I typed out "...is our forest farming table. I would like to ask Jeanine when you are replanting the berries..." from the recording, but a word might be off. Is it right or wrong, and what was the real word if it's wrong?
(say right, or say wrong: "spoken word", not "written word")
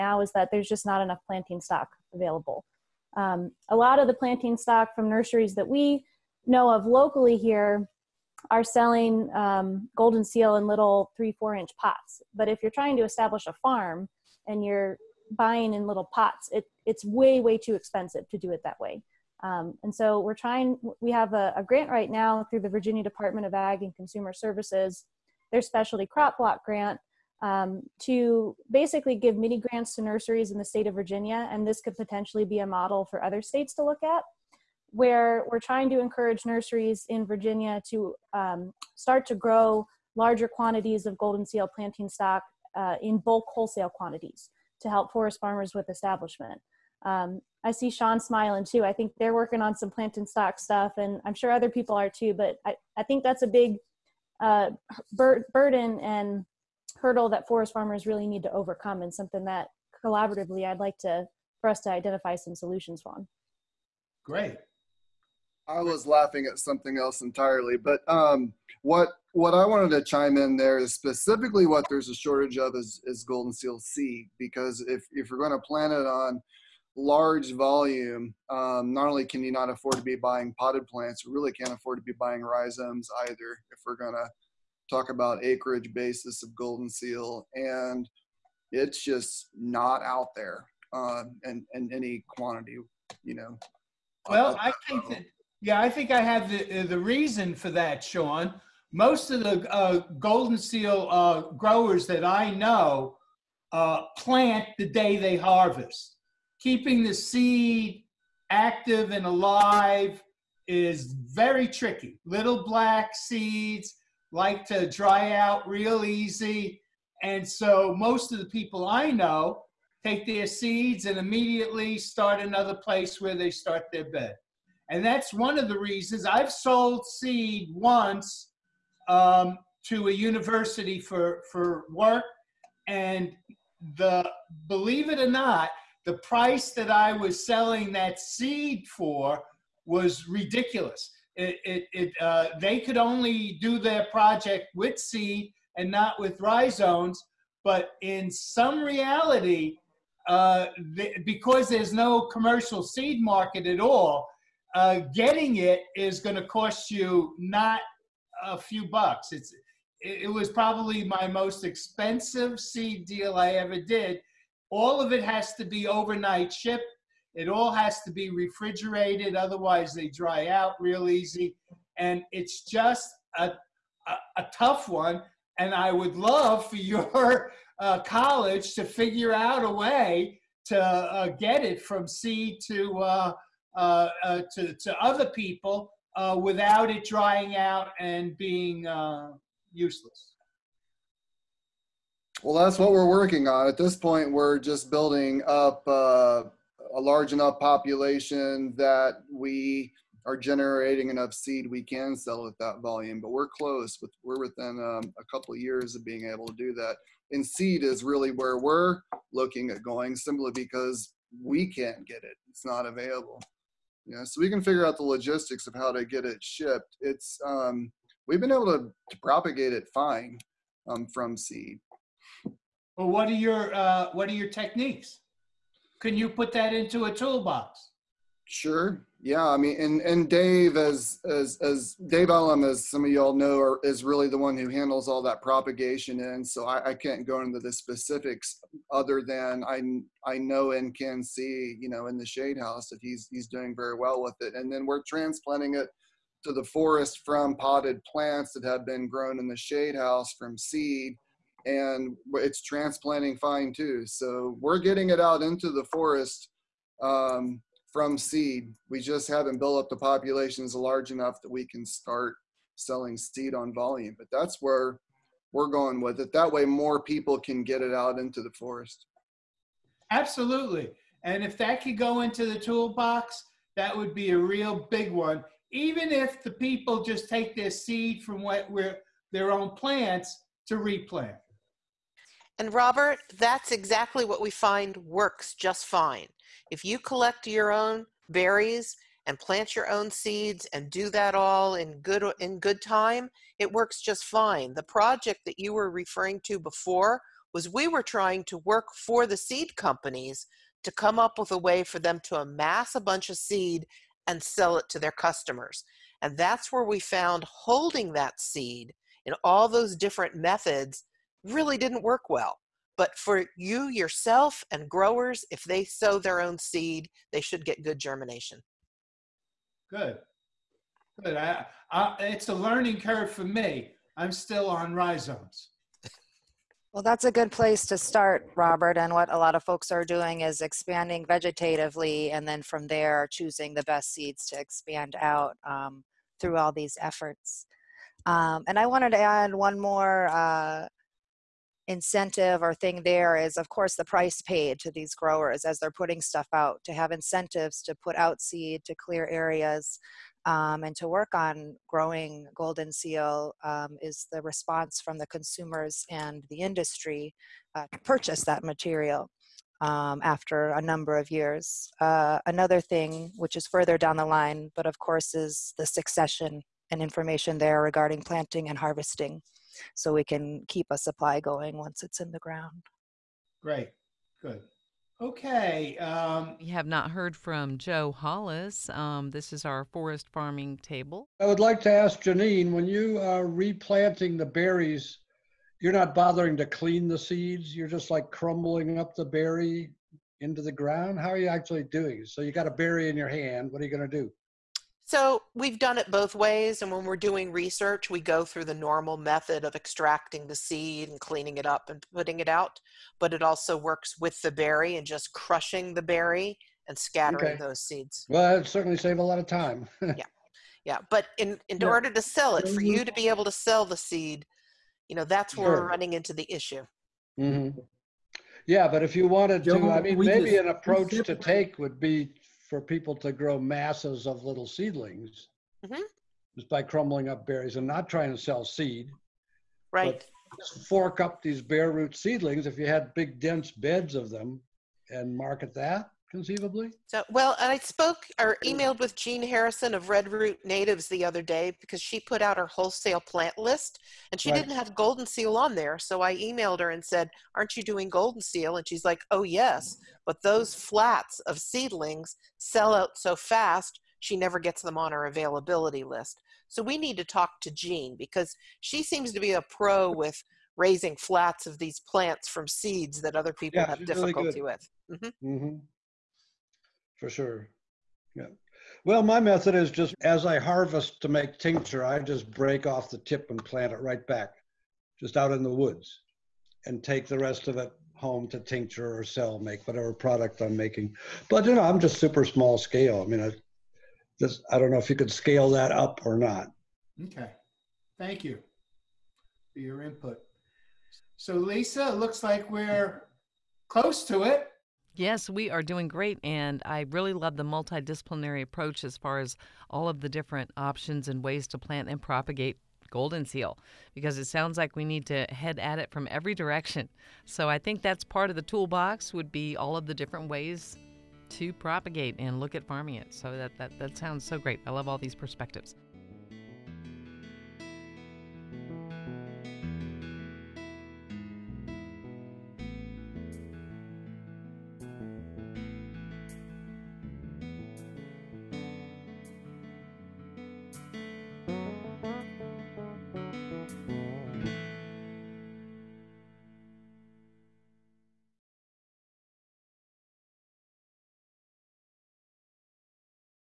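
right.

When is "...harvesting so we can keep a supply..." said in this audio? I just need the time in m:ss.
6:08.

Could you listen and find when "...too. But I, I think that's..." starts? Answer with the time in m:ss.
0:52.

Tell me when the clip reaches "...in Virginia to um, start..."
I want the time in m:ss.
0:37.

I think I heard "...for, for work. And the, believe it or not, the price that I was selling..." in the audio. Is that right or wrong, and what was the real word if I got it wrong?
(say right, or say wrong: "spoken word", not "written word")
right.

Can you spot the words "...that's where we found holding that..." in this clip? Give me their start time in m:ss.
5:06.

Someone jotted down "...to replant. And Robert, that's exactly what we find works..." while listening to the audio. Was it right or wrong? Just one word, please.
right.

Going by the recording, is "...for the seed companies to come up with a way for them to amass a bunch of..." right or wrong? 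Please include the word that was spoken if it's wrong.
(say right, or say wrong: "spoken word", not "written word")
right.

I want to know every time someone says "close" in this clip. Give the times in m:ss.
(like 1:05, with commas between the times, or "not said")
3:23, 8:13.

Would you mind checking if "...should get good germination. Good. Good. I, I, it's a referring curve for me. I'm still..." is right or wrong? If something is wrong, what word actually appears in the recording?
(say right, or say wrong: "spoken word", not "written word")
wrong: "learning", not "referring".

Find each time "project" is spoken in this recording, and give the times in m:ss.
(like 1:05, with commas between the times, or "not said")
2:24, 4:54.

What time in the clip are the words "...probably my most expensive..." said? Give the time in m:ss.
2:40.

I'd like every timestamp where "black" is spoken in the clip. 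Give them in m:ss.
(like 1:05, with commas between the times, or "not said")
1:52.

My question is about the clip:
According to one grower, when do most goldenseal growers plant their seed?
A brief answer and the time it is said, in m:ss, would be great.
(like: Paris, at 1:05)
The day they harvest, at 1:44.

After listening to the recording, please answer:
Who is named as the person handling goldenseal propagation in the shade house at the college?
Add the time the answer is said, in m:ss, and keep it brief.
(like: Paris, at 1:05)
Dave Ellum, at 3:52.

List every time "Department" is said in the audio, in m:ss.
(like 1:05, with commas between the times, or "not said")
0:23.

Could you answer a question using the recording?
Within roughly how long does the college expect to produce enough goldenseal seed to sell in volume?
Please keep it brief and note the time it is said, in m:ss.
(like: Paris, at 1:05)
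A couple of years, at 3:25.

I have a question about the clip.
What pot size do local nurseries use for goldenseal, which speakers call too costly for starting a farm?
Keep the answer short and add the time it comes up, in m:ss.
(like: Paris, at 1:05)
3-4 inch, at 0:11.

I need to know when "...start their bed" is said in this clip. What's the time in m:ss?
2:03.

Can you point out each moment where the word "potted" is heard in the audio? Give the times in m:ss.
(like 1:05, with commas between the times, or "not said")
1:20, 4:07.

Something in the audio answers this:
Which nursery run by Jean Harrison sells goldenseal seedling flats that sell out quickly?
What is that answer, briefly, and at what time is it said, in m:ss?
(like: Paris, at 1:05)
Red Root Natives, at 7:20.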